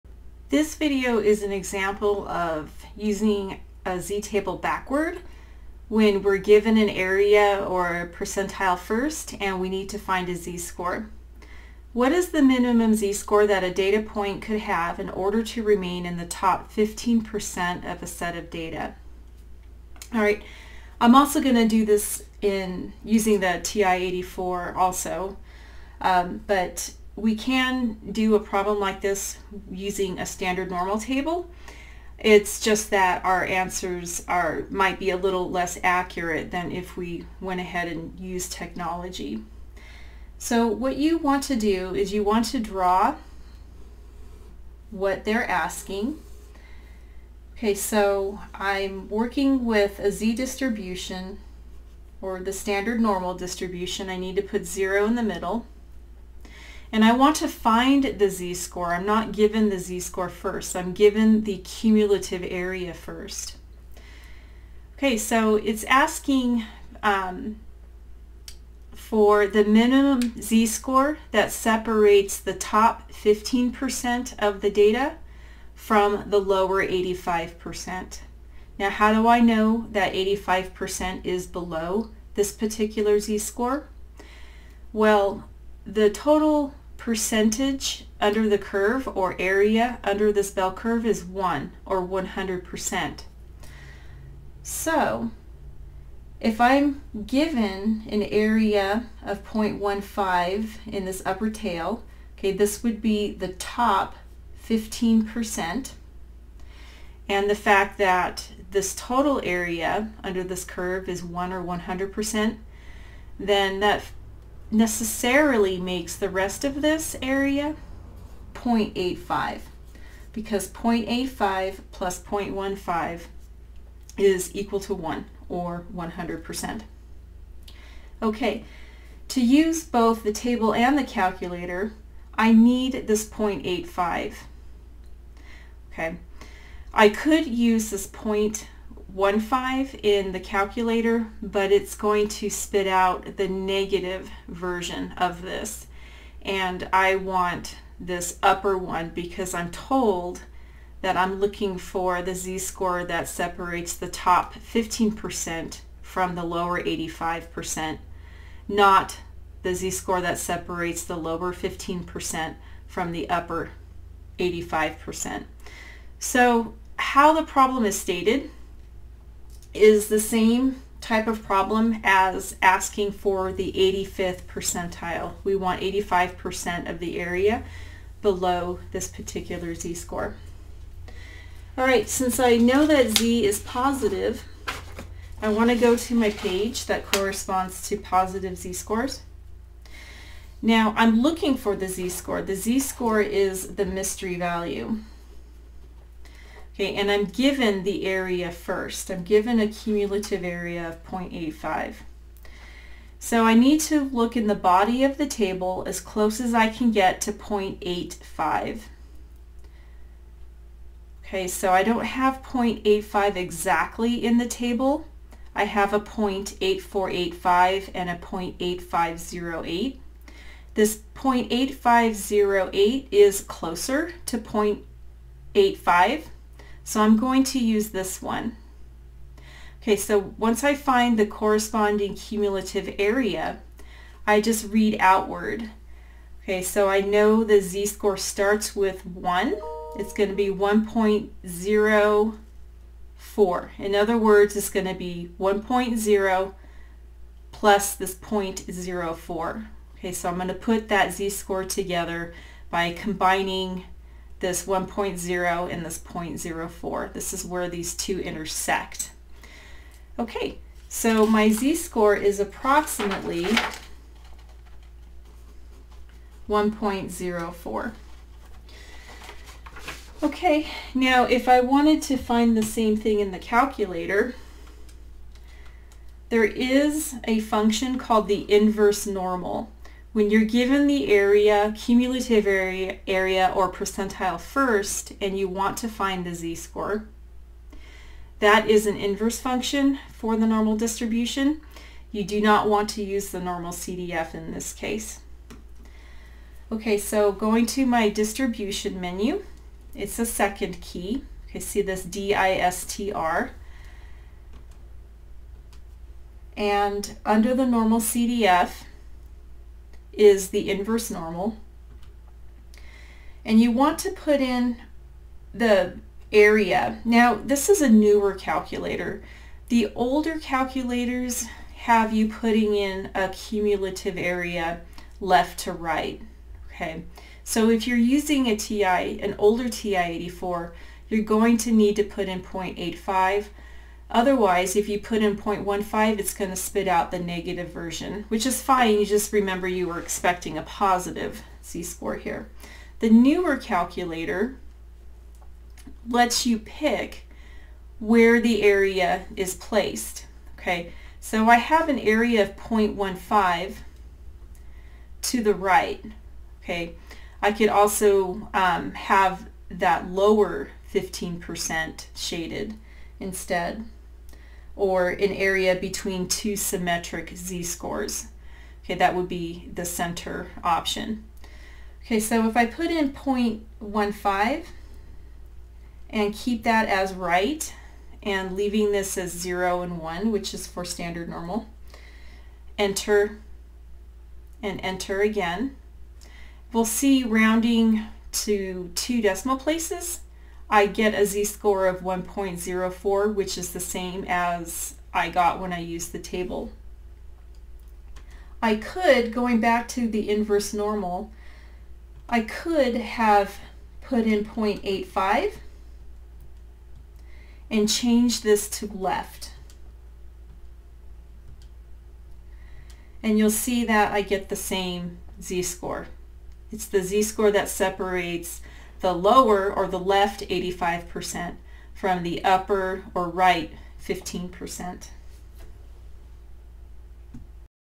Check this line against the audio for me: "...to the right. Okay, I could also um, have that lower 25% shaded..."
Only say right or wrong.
wrong.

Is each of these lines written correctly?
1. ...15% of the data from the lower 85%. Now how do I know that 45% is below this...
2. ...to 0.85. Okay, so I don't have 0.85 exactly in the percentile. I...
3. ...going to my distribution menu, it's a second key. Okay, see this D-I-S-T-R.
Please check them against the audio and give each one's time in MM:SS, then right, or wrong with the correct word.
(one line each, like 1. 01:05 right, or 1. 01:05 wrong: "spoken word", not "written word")
1. 01:13 wrong: "85", not "45"
2. 03:27 wrong: "table", not "percentile"
3. 04:57 right.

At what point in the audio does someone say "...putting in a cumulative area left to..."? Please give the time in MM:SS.
05:22.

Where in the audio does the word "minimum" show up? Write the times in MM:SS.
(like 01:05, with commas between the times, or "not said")
00:12, 01:09.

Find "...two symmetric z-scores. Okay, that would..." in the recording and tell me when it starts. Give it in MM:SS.
06:06.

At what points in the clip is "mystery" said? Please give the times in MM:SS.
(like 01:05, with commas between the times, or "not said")
03:13.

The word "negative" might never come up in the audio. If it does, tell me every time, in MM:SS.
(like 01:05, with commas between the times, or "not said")
02:23, 05:37.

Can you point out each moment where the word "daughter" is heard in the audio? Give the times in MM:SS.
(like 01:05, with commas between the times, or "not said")
not said.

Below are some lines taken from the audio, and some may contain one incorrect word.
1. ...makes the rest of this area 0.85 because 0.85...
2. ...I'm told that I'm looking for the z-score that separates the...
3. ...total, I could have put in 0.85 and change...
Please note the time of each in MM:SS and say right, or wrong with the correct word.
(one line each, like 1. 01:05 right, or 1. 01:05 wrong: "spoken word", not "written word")
1. 01:55 right
2. 02:29 right
3. 06:40 wrong: "normal", not "total".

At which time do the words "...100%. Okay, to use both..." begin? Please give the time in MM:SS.
02:05.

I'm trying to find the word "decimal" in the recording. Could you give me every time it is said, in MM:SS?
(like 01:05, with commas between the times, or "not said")
06:29.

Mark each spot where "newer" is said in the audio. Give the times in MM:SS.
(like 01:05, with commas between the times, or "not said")
05:17, 05:43.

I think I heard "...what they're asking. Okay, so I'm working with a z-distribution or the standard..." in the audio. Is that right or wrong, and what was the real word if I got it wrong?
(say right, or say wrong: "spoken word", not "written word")
right.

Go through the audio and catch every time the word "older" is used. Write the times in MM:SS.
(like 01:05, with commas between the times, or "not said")
05:19, 05:29.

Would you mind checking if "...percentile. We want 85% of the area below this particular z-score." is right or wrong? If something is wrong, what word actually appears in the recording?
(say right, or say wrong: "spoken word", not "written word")
right.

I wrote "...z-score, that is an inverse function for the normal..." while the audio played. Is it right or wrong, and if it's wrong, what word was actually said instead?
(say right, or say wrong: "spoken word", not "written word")
right.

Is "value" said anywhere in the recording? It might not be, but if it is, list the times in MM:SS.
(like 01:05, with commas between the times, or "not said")
03:14.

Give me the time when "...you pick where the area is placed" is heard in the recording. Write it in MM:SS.
05:46.